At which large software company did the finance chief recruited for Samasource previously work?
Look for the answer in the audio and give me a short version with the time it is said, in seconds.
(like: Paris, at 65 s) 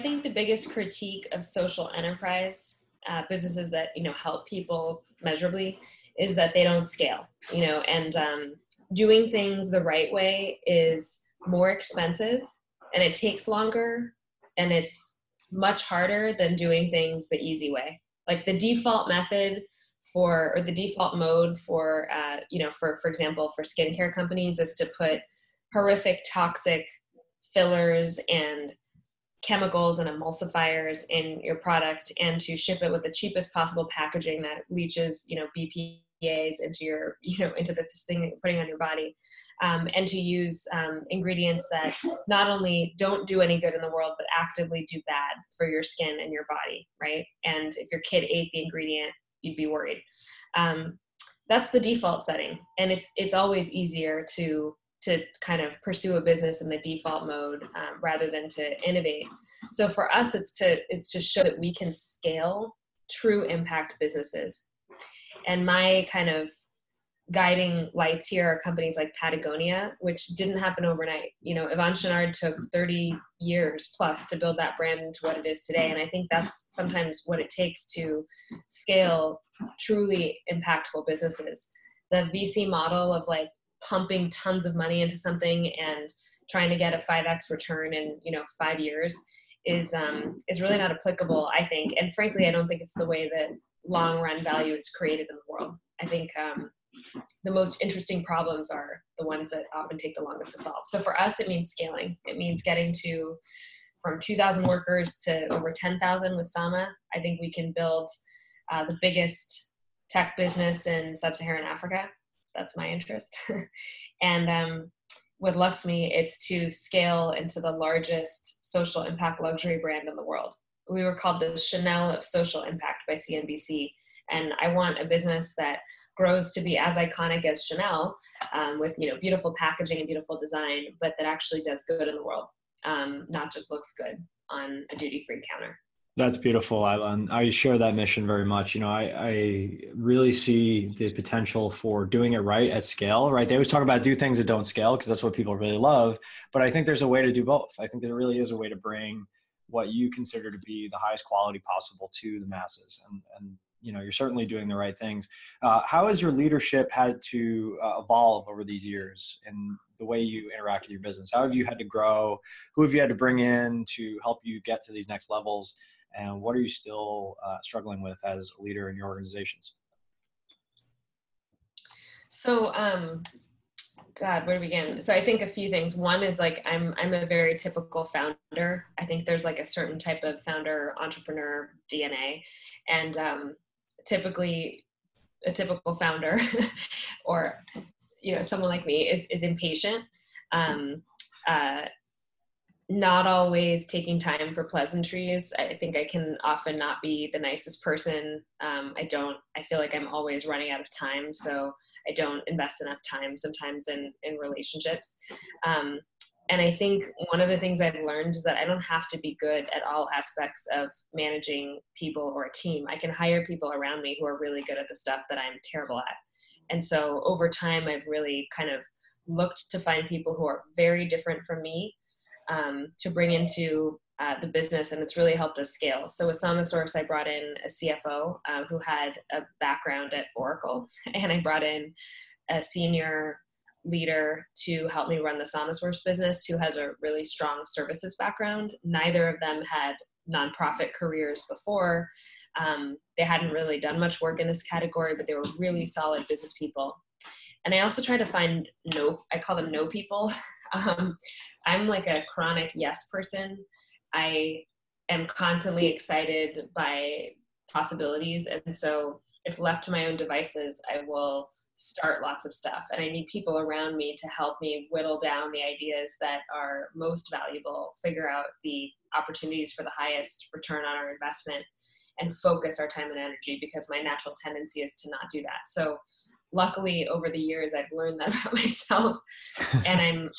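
Oracle, at 230 s.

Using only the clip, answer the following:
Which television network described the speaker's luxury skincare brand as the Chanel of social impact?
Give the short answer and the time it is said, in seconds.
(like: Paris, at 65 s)
CNBC, at 123 s.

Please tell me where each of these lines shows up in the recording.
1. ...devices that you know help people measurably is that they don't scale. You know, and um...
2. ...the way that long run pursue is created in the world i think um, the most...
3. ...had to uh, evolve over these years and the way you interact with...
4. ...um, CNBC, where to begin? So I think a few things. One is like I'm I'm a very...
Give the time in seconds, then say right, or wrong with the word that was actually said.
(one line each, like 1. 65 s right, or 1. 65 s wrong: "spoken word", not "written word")
1. 3 s wrong: "businesses", not "devices"
2. 92 s wrong: "value", not "pursue"
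3. 156 s right
4. 172 s wrong: "God", not "CNBC".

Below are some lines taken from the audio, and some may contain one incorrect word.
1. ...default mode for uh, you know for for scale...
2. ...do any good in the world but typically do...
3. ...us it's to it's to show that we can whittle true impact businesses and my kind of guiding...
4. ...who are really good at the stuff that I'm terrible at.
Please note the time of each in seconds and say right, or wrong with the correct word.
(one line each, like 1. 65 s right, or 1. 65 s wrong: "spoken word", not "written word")
1. 20 s wrong: "example", not "scale"
2. 43 s wrong: "actively", not "typically"
3. 60 s wrong: "scale", not "whittle"
4. 214 s right.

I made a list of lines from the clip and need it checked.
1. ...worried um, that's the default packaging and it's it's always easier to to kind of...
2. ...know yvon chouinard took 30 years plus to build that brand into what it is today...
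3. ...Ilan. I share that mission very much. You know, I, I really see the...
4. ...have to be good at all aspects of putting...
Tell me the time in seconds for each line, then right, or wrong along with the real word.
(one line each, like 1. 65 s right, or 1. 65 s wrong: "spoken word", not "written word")
1. 49 s wrong: "setting", not "packaging"
2. 71 s right
3. 136 s right
4. 208 s wrong: "managing", not "putting".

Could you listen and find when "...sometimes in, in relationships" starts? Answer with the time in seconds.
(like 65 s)
203 s.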